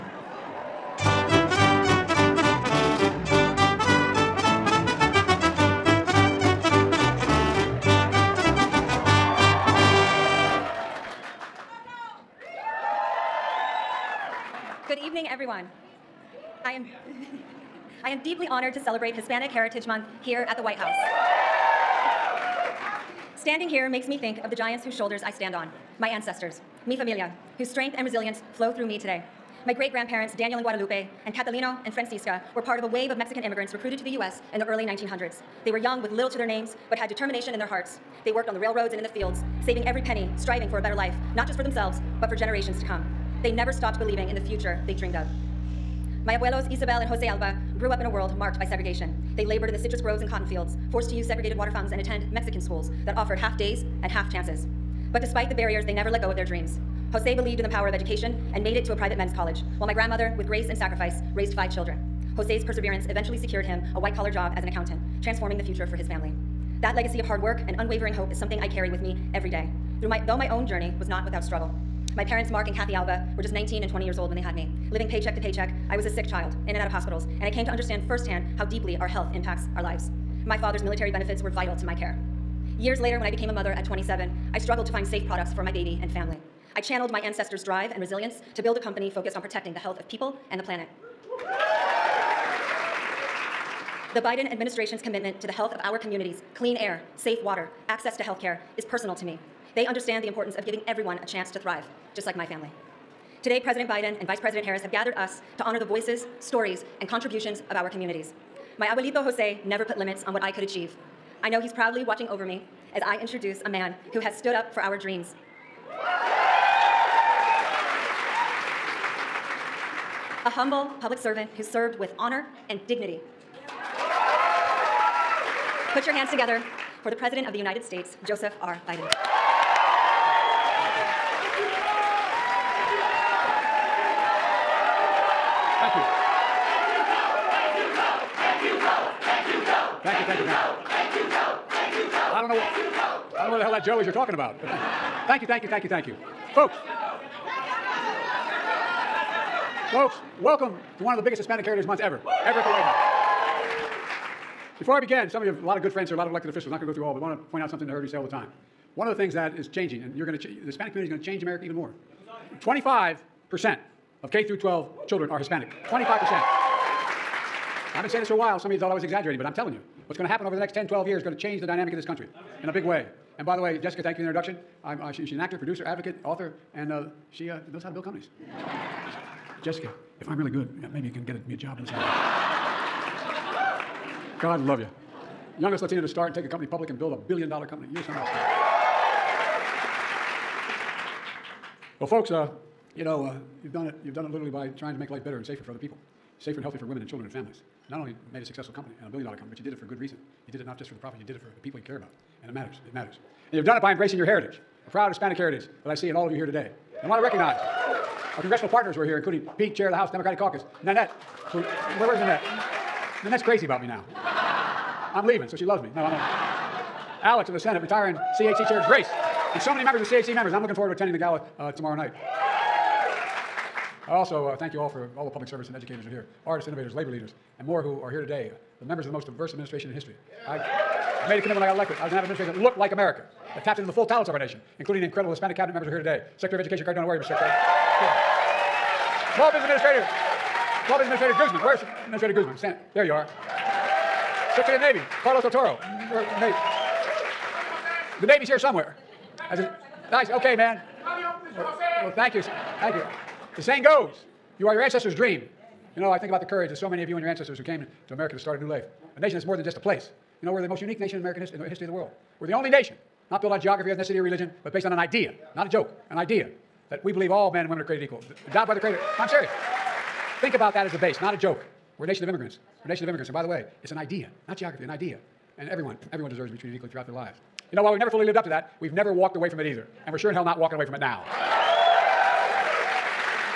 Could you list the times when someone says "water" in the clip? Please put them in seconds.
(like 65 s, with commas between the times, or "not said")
51 s, 97 s.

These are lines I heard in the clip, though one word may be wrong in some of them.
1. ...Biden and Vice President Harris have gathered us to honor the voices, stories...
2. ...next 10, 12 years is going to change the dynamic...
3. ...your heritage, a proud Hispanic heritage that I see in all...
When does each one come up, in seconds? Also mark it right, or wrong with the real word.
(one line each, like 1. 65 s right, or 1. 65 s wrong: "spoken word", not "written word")
1. 103 s right
2. 170 s right
3. 204 s right.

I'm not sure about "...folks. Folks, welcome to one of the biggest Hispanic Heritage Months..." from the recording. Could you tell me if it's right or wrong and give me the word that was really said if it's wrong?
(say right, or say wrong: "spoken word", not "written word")
right.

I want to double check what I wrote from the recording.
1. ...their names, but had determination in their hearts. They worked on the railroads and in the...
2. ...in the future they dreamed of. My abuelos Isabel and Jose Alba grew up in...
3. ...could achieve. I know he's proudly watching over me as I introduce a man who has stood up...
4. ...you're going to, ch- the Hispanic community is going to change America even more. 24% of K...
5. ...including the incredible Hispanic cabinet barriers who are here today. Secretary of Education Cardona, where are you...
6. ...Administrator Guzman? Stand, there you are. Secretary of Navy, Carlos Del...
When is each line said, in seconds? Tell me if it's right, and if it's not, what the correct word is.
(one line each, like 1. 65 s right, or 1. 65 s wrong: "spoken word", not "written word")
1. 36 s right
2. 44 s right
3. 110 s right
4. 160 s wrong: "25", not "24"
5. 234 s wrong: "members", not "barriers"
6. 242 s right.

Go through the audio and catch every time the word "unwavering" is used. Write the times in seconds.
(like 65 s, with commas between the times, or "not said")
67 s.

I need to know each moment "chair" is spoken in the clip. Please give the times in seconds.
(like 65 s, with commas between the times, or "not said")
209 s, 218 s.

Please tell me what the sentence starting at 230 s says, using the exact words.
I, made a commitment when I got elected.